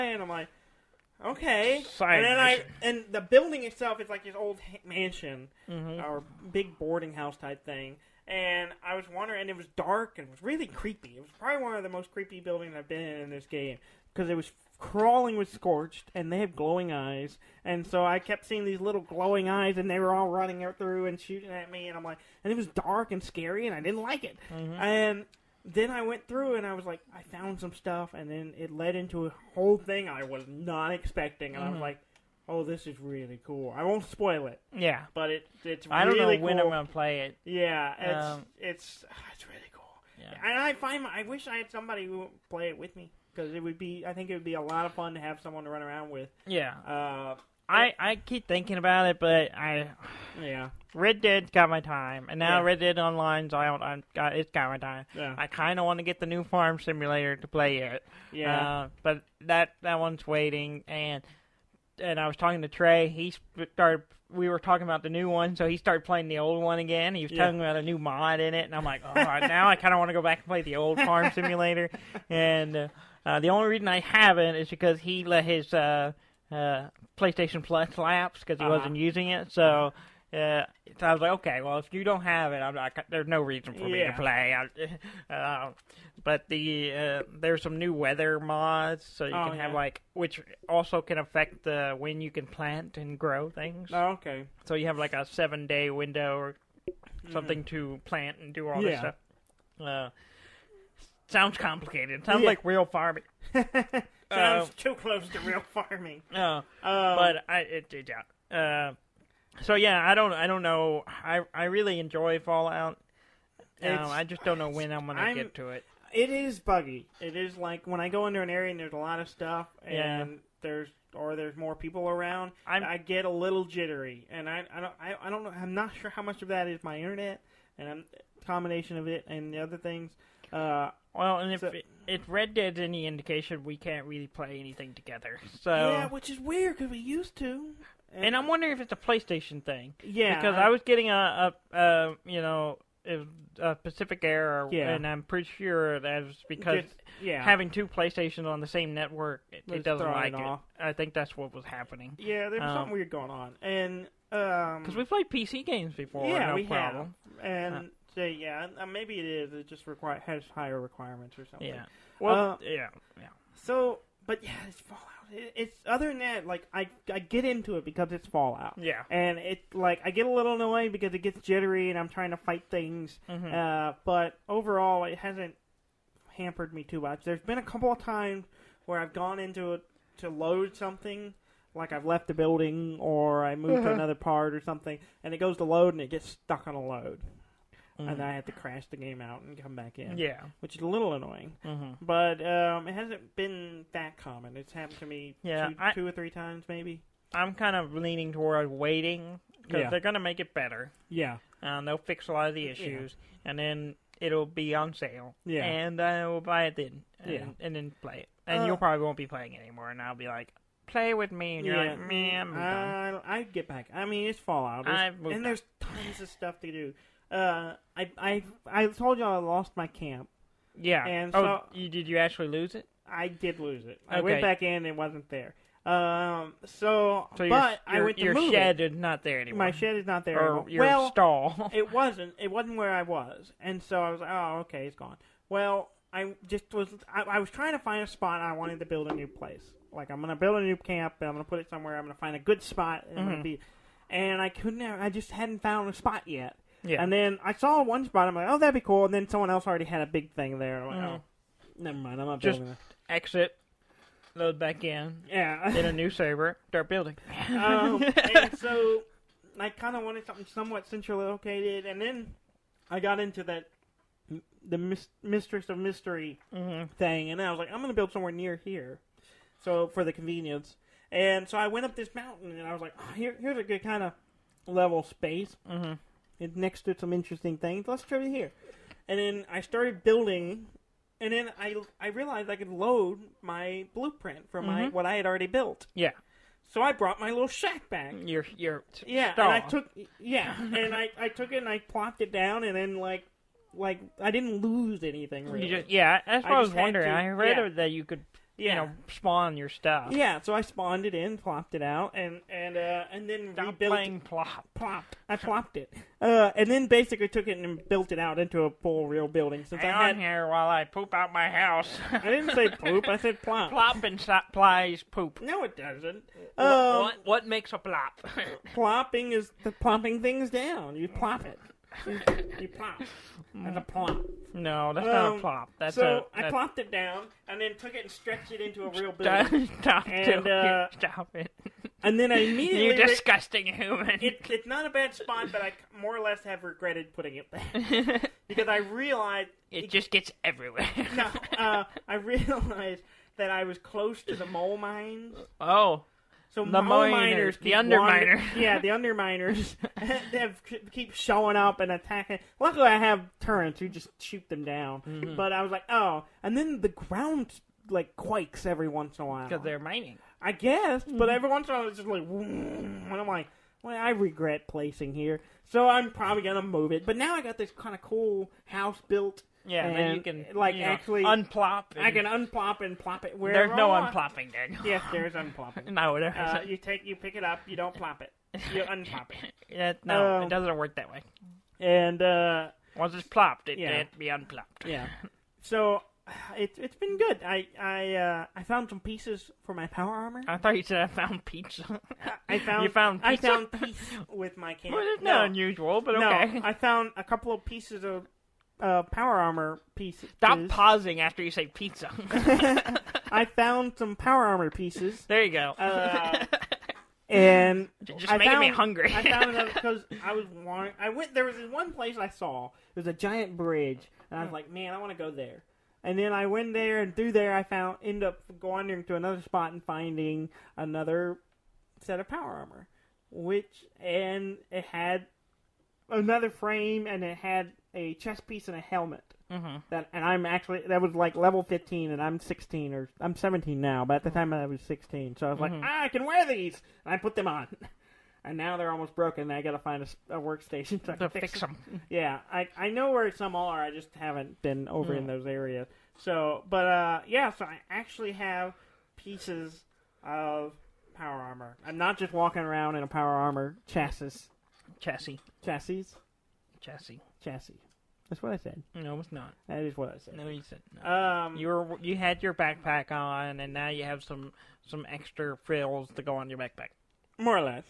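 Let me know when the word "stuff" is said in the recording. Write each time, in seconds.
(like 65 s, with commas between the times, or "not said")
27 s, 98 s, 119 s, 216 s, 299 s.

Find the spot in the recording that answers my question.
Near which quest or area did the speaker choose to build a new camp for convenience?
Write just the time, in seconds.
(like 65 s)
265 s.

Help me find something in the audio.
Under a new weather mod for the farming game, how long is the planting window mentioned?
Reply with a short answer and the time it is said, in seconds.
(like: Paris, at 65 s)
7 days, at 95 s.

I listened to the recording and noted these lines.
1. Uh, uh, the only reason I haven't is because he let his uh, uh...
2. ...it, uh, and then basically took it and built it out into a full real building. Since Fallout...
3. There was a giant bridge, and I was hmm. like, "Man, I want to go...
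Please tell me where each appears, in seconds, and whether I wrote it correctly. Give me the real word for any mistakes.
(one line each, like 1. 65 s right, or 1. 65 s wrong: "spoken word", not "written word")
1. 72 s right
2. 305 s wrong: "Hang", not "Fallout"
3. 412 s right.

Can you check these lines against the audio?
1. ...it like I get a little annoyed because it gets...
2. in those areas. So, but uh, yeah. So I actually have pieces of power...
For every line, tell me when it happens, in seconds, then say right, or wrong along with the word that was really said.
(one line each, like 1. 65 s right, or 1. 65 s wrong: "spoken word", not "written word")
1. 169 s right
2. 445 s right.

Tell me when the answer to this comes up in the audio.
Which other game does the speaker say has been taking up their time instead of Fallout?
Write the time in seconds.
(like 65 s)
52 s.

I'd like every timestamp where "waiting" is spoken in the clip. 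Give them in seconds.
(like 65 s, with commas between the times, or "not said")
60 s, 198 s.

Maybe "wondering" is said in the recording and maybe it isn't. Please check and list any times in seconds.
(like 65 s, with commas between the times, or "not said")
9 s, 138 s, 296 s.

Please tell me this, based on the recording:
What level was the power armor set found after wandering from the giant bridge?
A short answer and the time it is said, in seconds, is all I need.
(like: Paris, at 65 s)
15, at 431 s.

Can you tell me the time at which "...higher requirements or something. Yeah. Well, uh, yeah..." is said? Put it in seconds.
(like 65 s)
160 s.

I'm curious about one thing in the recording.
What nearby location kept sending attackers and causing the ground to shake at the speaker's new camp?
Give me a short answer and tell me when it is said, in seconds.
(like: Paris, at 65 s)
the mole mines, at 344 s.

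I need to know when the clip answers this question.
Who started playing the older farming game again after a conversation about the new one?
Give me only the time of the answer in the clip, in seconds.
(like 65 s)
62 s.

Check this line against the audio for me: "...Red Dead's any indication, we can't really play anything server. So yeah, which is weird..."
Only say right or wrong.
wrong.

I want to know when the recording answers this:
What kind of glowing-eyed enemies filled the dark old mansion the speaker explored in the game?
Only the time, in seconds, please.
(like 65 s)
15 s.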